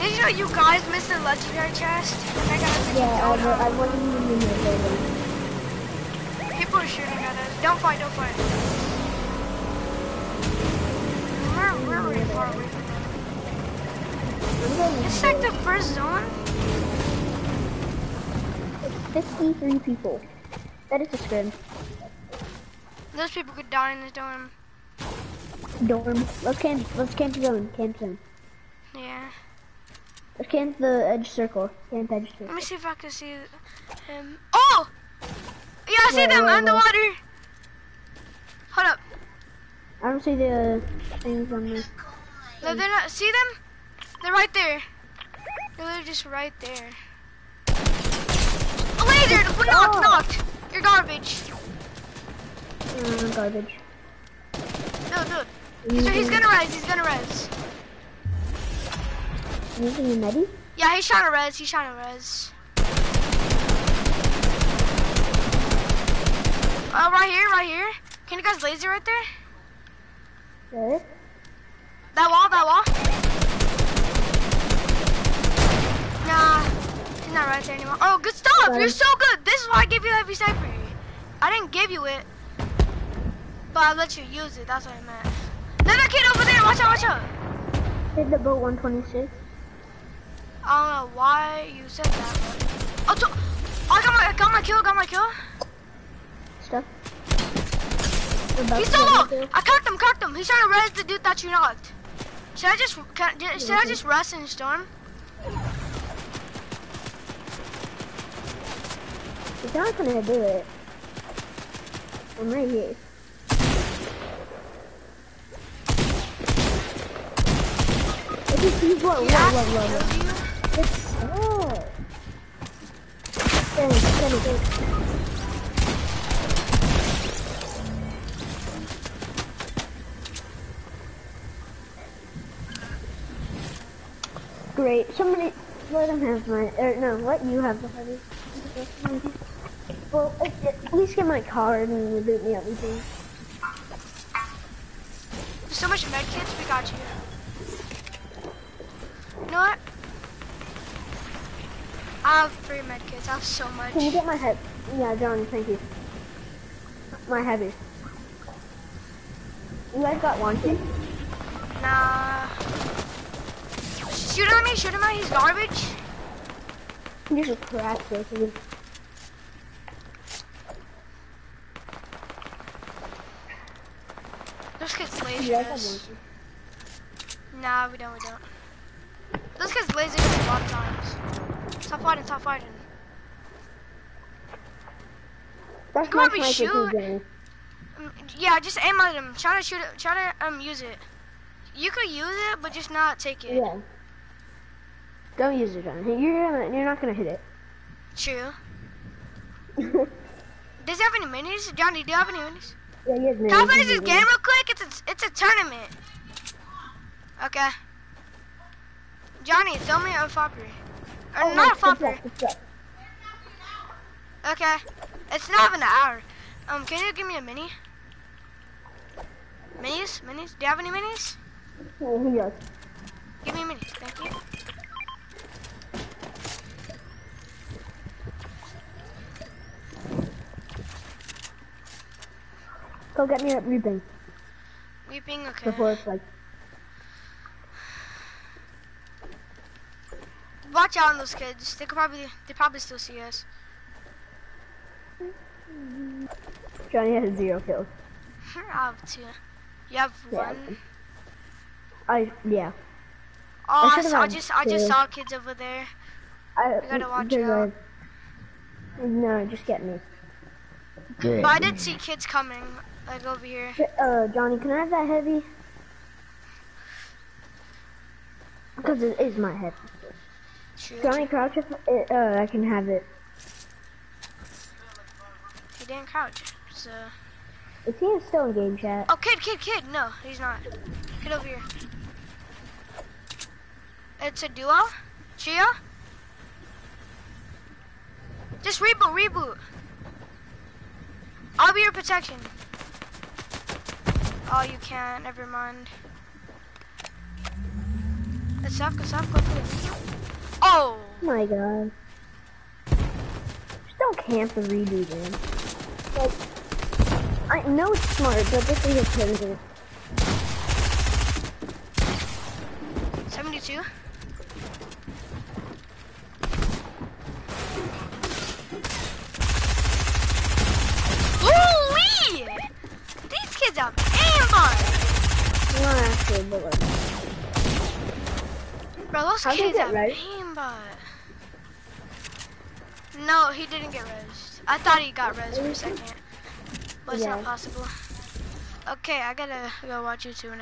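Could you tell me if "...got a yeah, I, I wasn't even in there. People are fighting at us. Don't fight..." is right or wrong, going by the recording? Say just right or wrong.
wrong.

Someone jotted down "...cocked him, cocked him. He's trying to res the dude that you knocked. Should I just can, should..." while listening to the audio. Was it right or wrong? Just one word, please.
right.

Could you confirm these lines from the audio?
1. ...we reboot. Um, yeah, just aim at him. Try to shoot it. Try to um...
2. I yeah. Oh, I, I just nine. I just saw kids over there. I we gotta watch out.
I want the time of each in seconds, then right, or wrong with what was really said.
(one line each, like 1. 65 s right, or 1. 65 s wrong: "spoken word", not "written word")
1. 186 s wrong: "shoot", not "reboot"
2. 252 s wrong: "two", not "nine".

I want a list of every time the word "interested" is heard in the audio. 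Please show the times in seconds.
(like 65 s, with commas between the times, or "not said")
not said.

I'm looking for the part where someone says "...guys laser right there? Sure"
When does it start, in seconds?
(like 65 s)
68 s.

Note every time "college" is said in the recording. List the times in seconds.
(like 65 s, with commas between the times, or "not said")
not said.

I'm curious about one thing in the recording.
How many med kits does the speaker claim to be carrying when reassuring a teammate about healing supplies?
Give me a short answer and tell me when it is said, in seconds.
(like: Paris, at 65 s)
3, at 152 s.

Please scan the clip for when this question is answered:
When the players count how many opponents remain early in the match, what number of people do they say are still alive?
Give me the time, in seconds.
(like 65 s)
19 s.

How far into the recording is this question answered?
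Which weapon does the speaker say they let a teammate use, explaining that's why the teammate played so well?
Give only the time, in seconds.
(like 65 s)
80 s.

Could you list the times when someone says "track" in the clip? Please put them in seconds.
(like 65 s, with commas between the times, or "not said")
not said.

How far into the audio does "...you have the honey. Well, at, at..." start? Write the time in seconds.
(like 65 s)
137 s.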